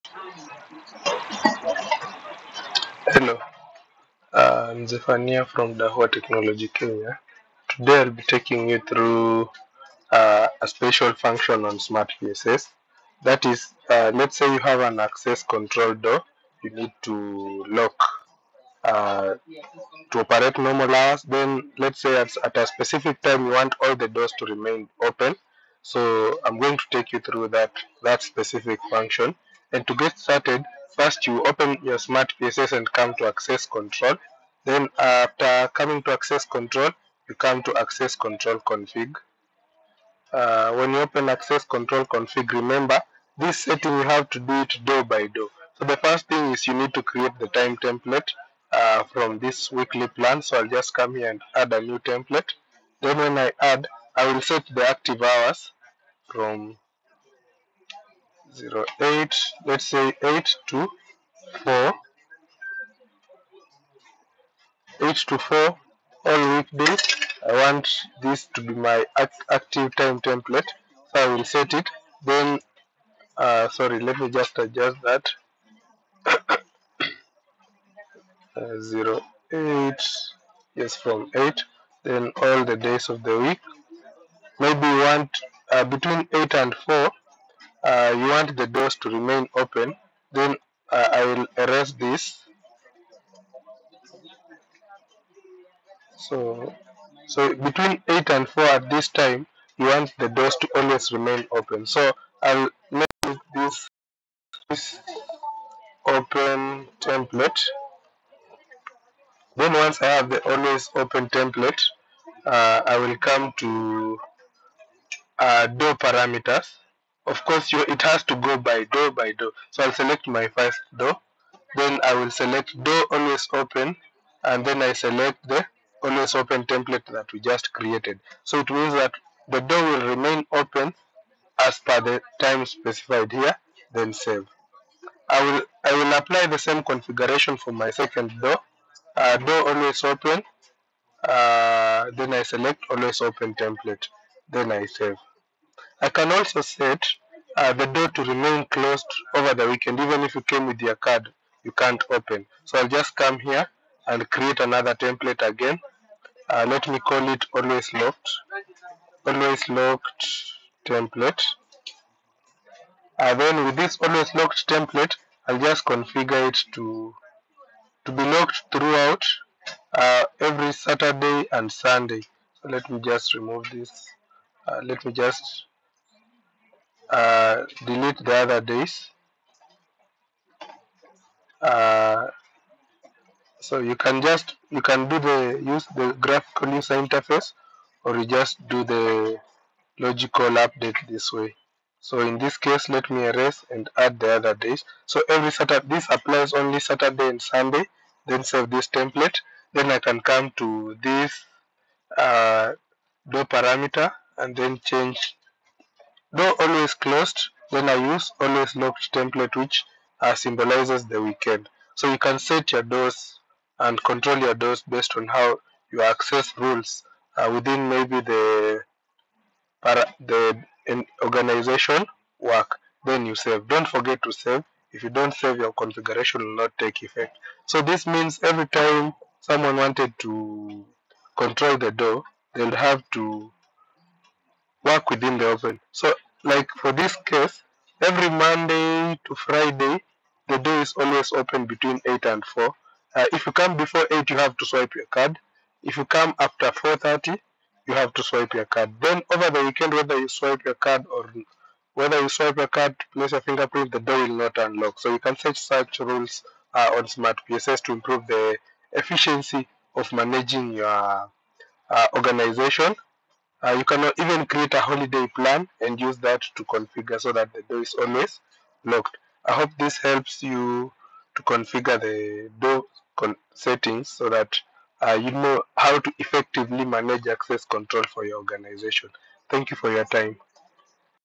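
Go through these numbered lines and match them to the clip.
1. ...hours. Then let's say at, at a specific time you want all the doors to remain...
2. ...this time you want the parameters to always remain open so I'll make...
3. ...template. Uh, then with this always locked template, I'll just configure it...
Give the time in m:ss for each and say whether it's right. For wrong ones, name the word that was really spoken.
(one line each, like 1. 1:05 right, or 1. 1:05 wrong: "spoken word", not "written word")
1. 0:20 right
2. 1:38 wrong: "doors", not "parameters"
3. 2:40 right.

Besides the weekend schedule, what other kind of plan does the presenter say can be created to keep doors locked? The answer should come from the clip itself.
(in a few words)
Holiday plan.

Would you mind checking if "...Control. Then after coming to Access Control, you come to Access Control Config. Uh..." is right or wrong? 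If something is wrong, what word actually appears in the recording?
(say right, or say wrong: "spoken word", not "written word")
right.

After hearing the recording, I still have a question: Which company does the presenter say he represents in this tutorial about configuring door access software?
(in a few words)
Dahua Technology Kenya.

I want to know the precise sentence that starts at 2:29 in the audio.
Even if you came with your card, you can't open.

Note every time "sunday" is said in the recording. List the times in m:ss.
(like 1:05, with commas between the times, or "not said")
2:51, 3:17.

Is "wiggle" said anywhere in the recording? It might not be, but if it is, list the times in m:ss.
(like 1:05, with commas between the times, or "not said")
not said.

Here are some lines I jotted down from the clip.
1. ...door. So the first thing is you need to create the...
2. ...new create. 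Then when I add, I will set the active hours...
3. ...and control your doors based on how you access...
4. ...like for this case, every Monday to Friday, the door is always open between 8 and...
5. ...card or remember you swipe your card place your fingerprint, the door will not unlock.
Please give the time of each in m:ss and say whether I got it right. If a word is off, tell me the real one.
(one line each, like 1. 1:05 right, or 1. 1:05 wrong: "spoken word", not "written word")
1. 0:45 right
2. 0:51 wrong: "template", not "create"
3. 3:33 right
4. 3:56 right
5. 4:10 wrong: "whether", not "remember".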